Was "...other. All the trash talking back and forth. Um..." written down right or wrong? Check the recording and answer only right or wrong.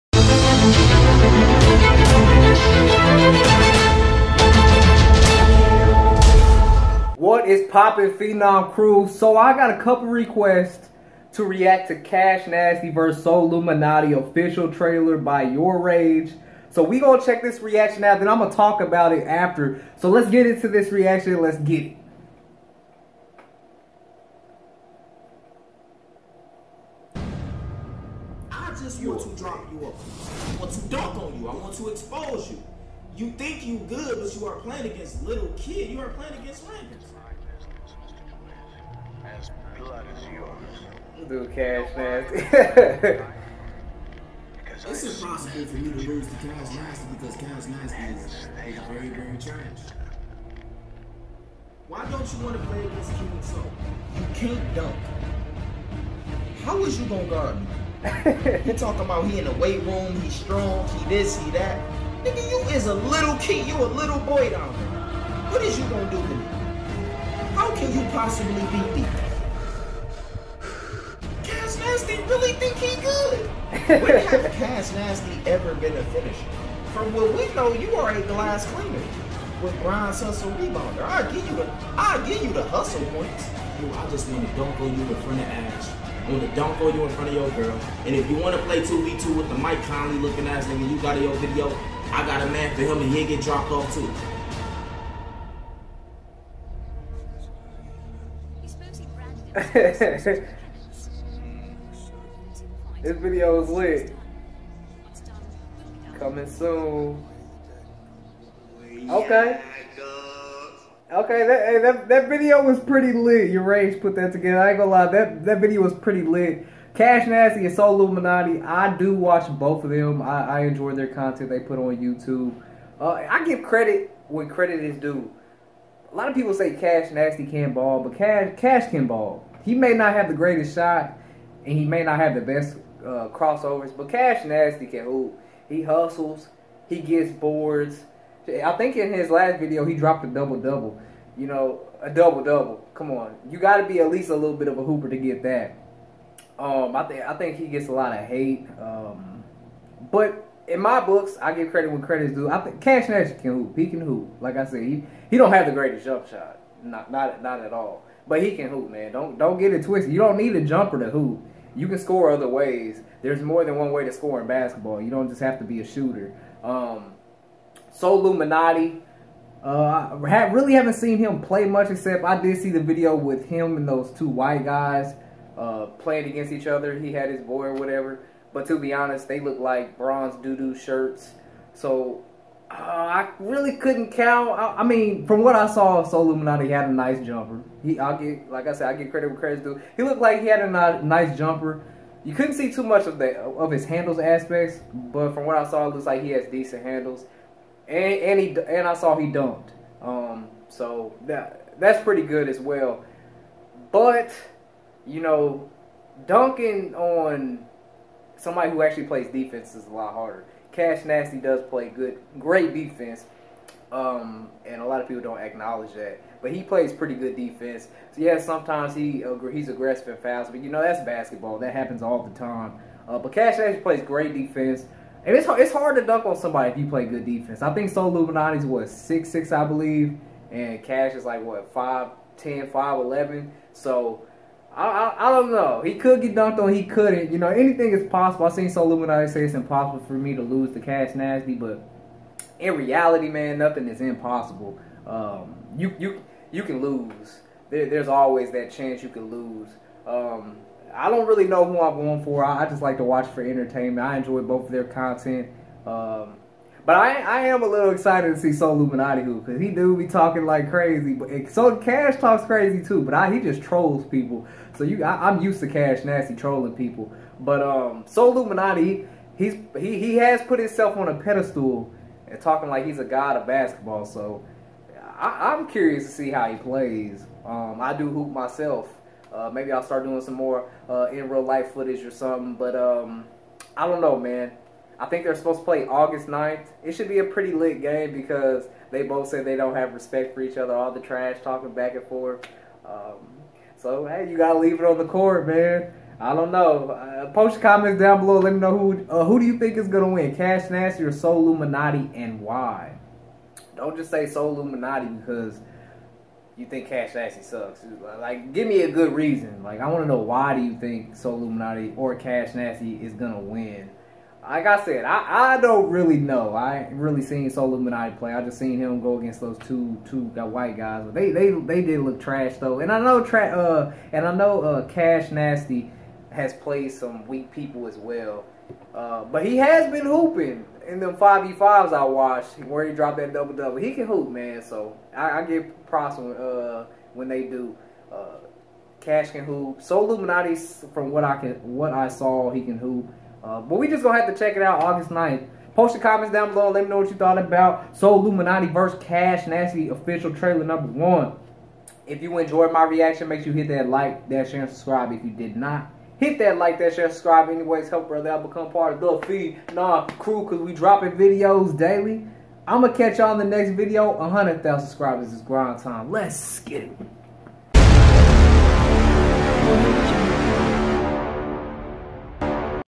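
right.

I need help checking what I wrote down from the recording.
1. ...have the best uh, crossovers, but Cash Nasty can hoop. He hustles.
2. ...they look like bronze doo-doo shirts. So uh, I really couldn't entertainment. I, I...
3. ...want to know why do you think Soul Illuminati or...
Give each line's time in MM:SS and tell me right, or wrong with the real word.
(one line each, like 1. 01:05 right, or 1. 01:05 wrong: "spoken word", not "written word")
1. 02:12 right
2. 02:59 wrong: "count", not "entertainment"
3. 05:09 right.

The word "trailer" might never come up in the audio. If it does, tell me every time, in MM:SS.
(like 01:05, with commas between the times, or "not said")
00:14, 05:50.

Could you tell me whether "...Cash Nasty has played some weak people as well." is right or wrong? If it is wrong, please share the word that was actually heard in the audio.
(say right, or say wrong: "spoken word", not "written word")
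right.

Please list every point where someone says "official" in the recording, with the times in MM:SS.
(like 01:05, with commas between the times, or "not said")
00:14, 05:49.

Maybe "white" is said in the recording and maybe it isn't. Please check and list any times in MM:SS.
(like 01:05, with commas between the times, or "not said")
02:54, 05:20.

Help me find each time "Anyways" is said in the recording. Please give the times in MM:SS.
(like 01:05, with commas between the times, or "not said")
05:57.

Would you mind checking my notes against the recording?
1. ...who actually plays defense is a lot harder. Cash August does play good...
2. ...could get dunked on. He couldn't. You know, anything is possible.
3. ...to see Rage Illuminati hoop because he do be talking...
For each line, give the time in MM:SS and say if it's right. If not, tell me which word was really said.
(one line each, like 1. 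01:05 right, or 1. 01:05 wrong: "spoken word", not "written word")
1. 03:28 wrong: "Nasty", not "August"
2. 03:55 right
3. 04:18 wrong: "Soul", not "Rage".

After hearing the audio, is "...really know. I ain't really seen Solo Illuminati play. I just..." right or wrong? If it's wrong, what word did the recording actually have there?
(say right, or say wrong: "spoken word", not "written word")
wrong: "Minati", not "Illuminati".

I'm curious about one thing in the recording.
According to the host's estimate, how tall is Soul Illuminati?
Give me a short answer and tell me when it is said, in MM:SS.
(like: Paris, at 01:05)
6'6", at 03:48.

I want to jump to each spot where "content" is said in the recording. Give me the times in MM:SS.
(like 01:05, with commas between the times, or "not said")
02:01, 04:14.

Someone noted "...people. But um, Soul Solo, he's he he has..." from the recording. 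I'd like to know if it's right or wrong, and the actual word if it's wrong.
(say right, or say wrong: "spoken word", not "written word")
wrong: "Illuminati", not "Solo".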